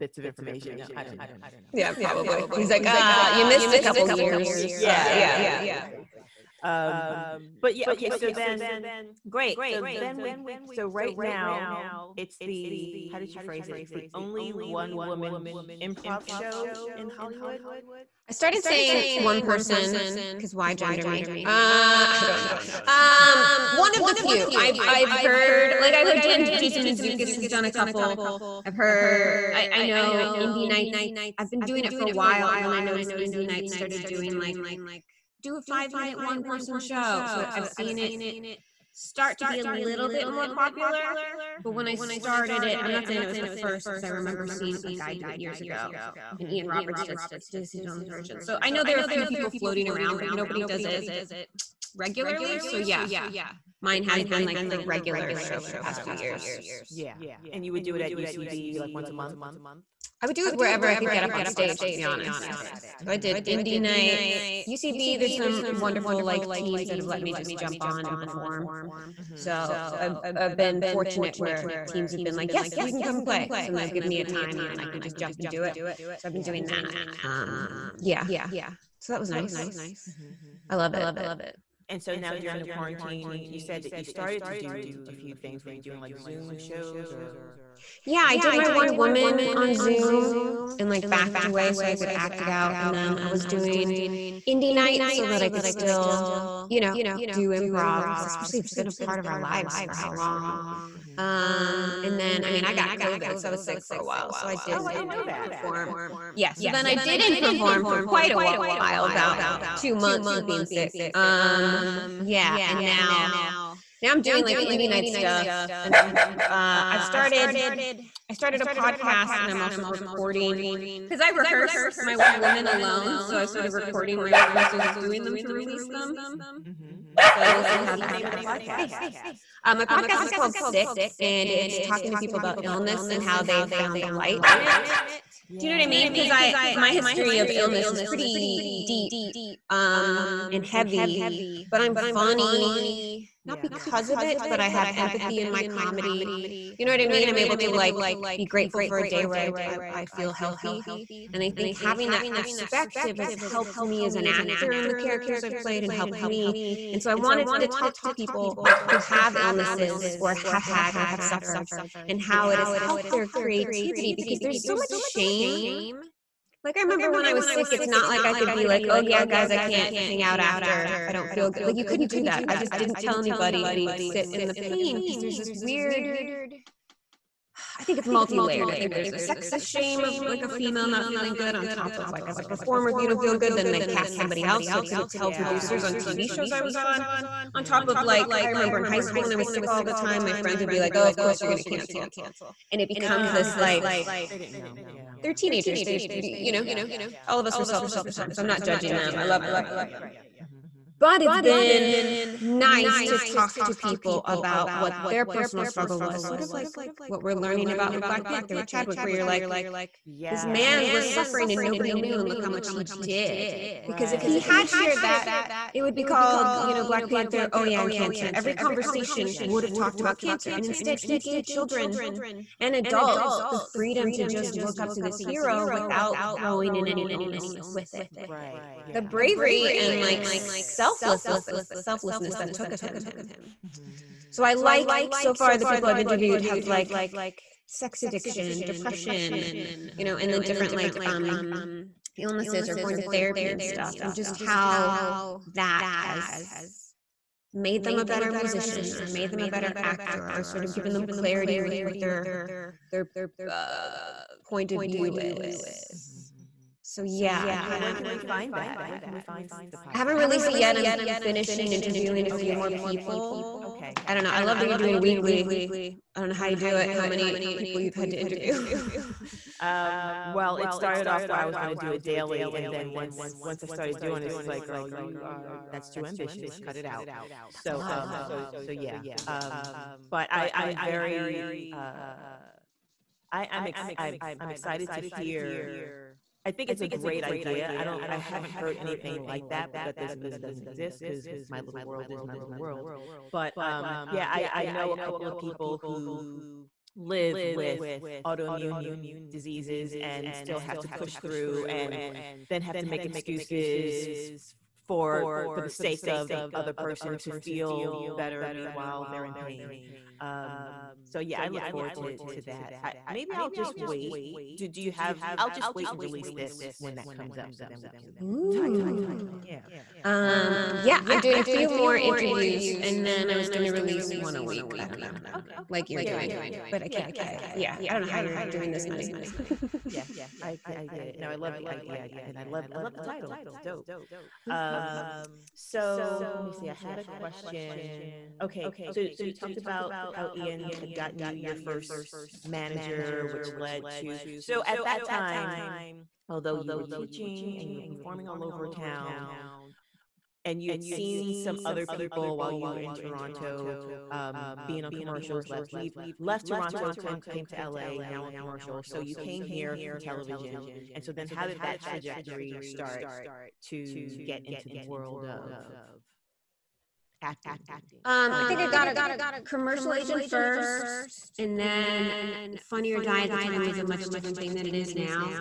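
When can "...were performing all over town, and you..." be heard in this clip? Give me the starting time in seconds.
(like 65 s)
347 s.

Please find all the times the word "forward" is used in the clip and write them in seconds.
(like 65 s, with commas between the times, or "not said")
311 s.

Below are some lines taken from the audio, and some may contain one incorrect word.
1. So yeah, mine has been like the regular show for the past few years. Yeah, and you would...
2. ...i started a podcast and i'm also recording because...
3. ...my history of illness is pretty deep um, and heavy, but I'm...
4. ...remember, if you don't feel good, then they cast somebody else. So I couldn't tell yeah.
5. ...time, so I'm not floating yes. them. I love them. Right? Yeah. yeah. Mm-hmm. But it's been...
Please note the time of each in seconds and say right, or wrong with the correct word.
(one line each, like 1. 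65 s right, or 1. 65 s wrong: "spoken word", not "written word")
1. 52 s right
2. 118 s right
3. 136 s right
4. 182 s wrong: "performer", not "remember"
5. 198 s wrong: "judging", not "floating".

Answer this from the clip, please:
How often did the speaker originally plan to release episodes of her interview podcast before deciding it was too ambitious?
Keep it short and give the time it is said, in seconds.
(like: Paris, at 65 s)
Daily, at 272 s.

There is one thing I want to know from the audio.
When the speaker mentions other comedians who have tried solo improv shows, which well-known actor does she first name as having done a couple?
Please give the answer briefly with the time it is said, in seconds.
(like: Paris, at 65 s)
Jason Mantzoukas, at 26 s.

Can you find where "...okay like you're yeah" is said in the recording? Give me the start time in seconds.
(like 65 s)
325 s.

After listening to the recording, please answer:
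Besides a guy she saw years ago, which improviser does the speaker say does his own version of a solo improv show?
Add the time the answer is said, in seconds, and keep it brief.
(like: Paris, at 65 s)
Ian Roberts, at 46 s.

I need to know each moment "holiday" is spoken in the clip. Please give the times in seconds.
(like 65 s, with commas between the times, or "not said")
not said.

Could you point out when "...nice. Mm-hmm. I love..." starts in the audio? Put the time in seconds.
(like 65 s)
79 s.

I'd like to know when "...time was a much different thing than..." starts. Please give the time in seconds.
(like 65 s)
373 s.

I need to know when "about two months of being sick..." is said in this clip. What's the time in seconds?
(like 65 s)
109 s.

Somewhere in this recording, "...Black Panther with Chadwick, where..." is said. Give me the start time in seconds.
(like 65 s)
208 s.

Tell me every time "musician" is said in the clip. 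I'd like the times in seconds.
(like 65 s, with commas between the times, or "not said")
248 s.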